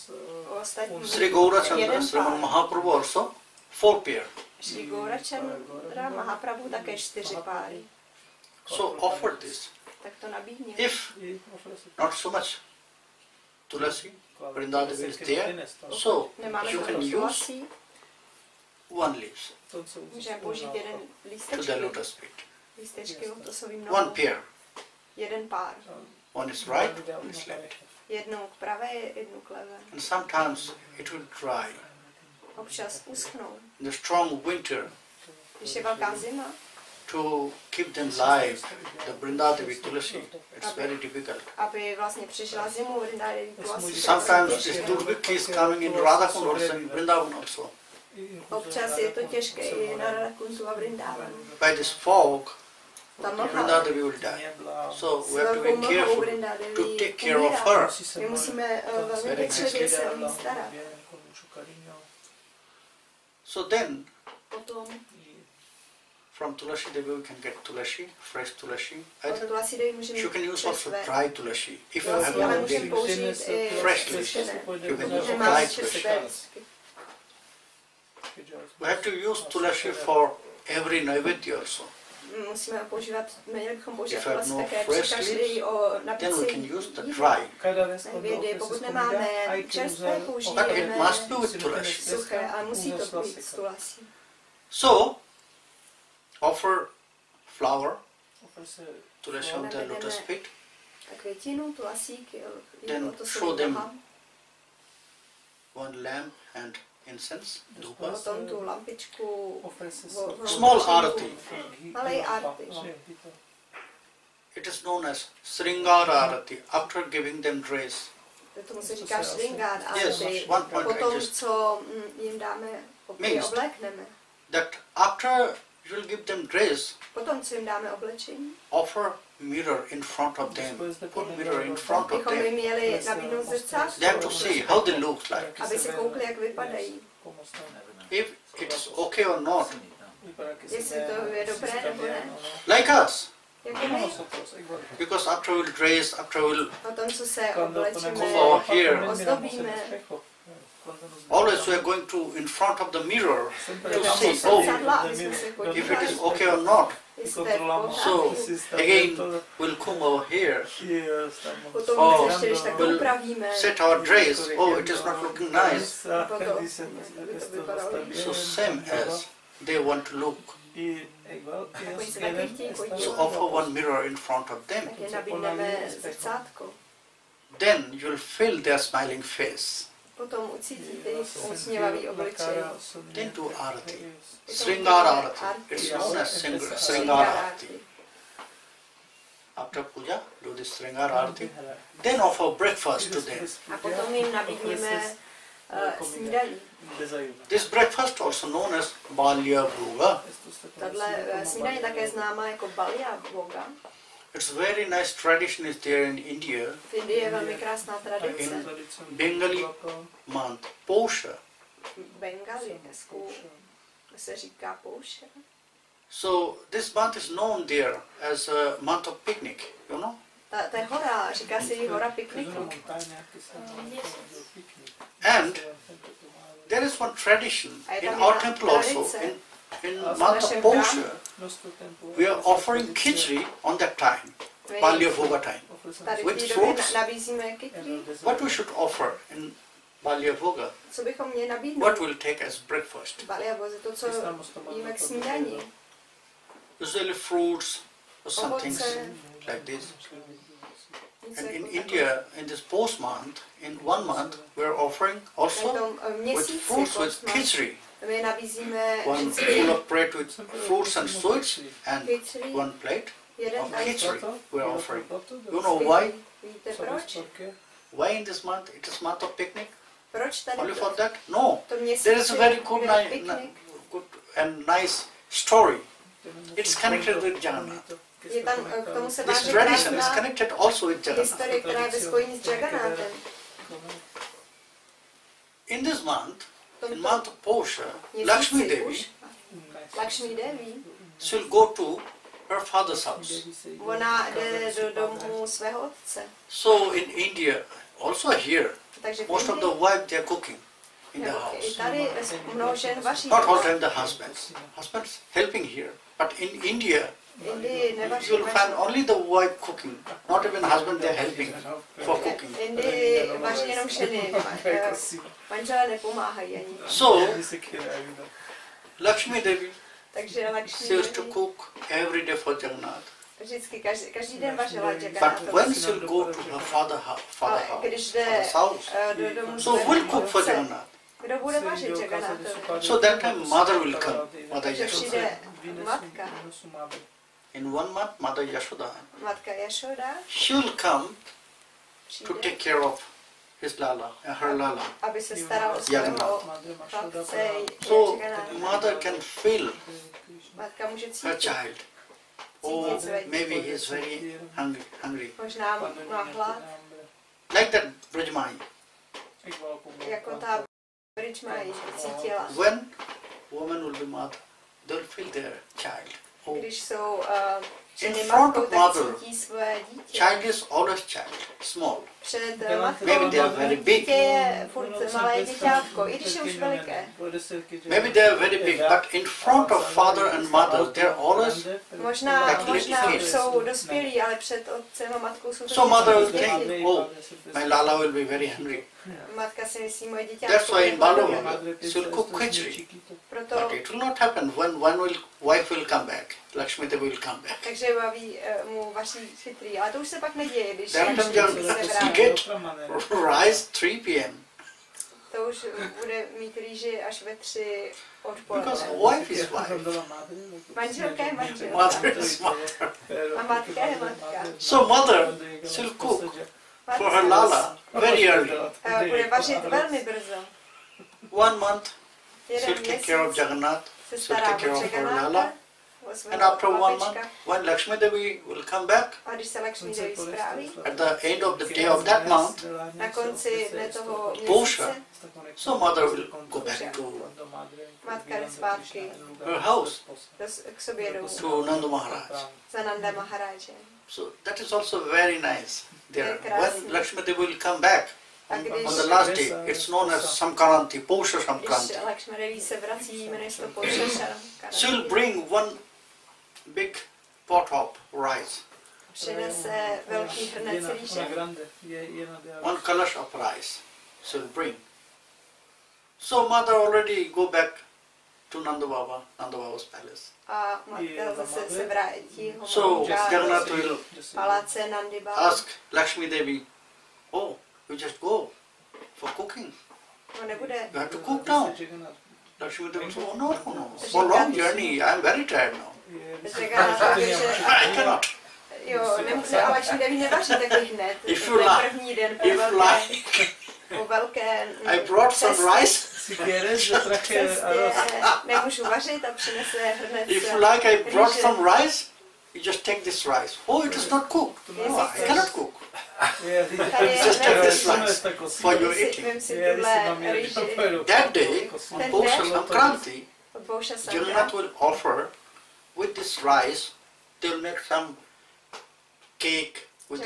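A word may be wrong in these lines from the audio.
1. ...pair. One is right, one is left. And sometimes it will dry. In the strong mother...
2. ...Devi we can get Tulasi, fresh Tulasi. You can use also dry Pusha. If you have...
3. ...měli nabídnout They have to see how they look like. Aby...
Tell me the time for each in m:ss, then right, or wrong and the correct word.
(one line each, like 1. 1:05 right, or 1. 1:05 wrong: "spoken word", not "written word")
1. 0:24 wrong: "winter", not "mother"
2. 1:06 wrong: "Tulasi", not "Pusha"
3. 2:12 right.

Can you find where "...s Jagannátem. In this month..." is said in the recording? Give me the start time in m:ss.
4:42.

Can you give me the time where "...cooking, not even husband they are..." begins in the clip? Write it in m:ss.
5:09.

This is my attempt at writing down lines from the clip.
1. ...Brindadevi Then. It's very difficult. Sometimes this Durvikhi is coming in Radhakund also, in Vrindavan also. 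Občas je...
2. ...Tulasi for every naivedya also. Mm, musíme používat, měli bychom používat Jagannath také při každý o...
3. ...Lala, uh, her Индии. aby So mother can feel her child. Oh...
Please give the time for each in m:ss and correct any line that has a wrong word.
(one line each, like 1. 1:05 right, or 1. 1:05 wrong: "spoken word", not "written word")
1. 0:39 wrong: "Tulasi", not "Then"
2. 1:19 wrong: "Tulasi", not "Jagannath"
3. 5:43 wrong: "Lala", not "Индии".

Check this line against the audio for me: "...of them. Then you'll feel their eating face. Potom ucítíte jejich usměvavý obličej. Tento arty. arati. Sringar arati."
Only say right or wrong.
wrong.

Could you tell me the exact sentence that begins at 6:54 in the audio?
So mother she'll cook for her lala very early.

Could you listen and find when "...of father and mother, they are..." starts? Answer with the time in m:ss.
6:19.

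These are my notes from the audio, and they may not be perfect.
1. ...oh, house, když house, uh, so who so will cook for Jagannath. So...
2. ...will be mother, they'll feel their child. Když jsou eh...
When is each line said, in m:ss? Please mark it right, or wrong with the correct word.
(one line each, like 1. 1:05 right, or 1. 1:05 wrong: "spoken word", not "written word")
1. 5:27 right
2. 6:03 right.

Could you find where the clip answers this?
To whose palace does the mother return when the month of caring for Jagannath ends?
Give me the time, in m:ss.
7:16.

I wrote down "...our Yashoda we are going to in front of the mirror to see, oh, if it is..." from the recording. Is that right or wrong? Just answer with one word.
wrong.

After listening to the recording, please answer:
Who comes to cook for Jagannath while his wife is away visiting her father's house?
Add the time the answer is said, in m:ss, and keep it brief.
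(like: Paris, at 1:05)
Mother Yashoda, at 5:38.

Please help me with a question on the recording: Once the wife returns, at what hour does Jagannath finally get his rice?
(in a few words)
3 p.m.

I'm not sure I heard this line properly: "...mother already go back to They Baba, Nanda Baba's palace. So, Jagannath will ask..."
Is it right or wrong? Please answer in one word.
wrong.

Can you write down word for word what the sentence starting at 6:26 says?
think, oh, my Lala will be very hungry.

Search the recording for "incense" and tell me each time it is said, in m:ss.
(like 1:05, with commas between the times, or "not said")
1:47.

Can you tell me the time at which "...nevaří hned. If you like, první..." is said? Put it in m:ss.
8:10.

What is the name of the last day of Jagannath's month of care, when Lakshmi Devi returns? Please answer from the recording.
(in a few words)
Posha Samkaranti.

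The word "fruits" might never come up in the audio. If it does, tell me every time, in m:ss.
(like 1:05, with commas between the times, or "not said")
3:56, 4:07, 4:16, 4:20.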